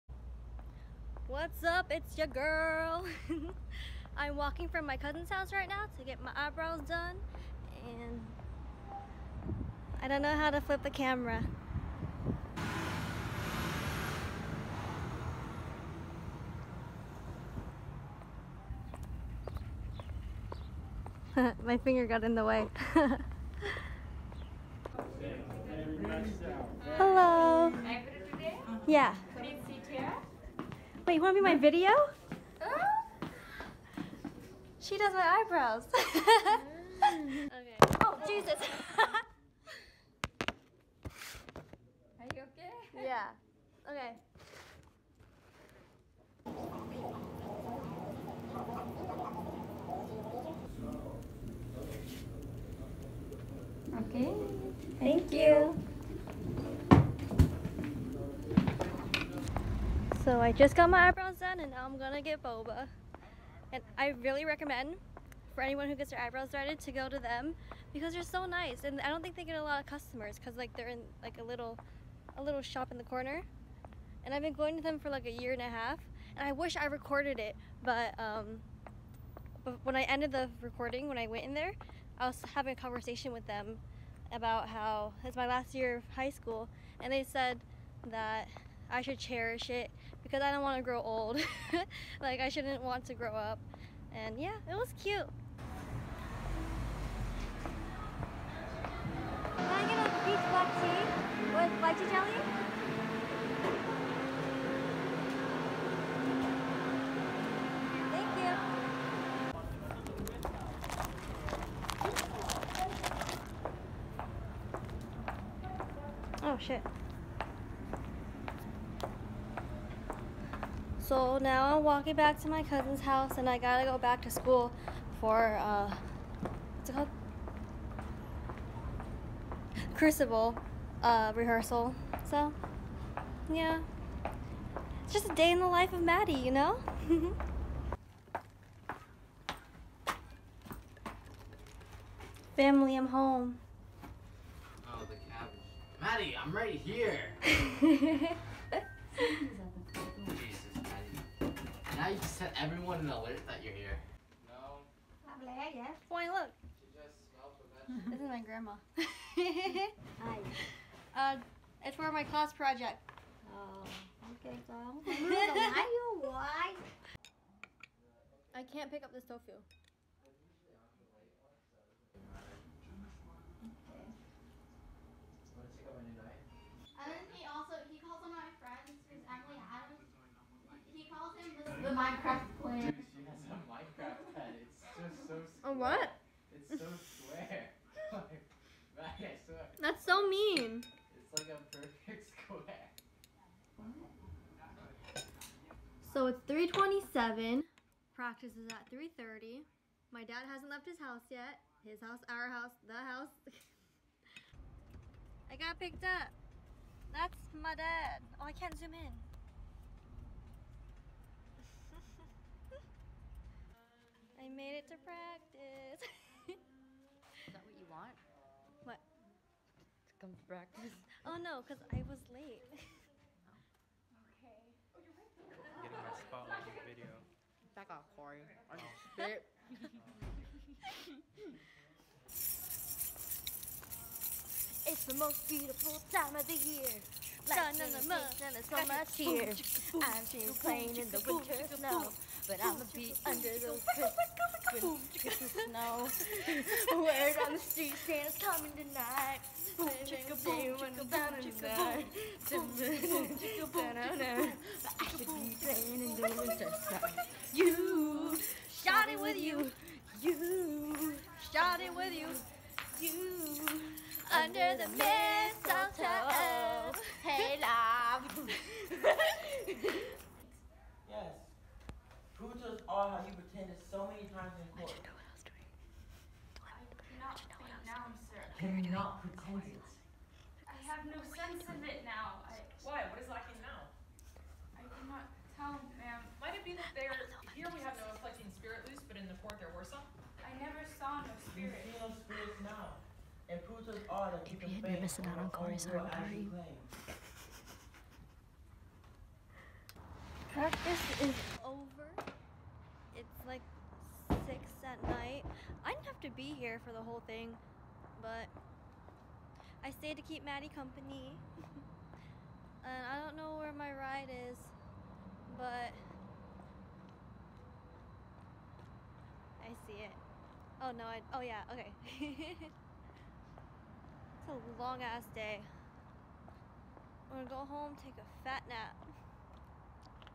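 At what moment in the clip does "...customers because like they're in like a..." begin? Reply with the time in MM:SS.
01:09.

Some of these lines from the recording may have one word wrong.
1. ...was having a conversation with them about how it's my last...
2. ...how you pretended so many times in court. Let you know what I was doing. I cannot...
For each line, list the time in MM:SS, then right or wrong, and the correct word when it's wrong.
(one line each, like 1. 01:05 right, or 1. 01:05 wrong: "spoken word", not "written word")
1. 01:22 right
2. 04:33 right.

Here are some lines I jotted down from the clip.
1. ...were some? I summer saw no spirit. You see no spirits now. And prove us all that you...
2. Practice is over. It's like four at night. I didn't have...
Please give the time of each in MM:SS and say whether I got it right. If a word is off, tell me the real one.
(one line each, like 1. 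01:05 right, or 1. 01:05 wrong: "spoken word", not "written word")
1. 04:49 wrong: "never", not "summer"
2. 05:00 wrong: "six", not "four".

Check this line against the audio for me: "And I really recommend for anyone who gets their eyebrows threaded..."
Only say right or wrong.
right.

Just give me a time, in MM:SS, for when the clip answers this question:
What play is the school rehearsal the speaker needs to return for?
02:09.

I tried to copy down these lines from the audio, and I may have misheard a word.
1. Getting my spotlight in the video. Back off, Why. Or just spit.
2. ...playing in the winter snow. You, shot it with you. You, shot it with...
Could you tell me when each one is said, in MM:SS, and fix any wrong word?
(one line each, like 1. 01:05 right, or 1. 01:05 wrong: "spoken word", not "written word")
1. 03:45 wrong: "Corey", not "Why"
2. 04:15 right.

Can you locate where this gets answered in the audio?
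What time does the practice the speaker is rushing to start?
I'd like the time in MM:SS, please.
03:18.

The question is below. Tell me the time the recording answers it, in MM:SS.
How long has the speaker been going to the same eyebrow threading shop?
01:15.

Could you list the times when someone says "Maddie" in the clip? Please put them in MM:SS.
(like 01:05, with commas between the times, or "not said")
02:16, 02:26, 05:10.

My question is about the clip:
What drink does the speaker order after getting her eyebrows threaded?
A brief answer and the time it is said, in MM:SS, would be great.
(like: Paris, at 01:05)
Peach black tea with lychee jelly, at 01:40.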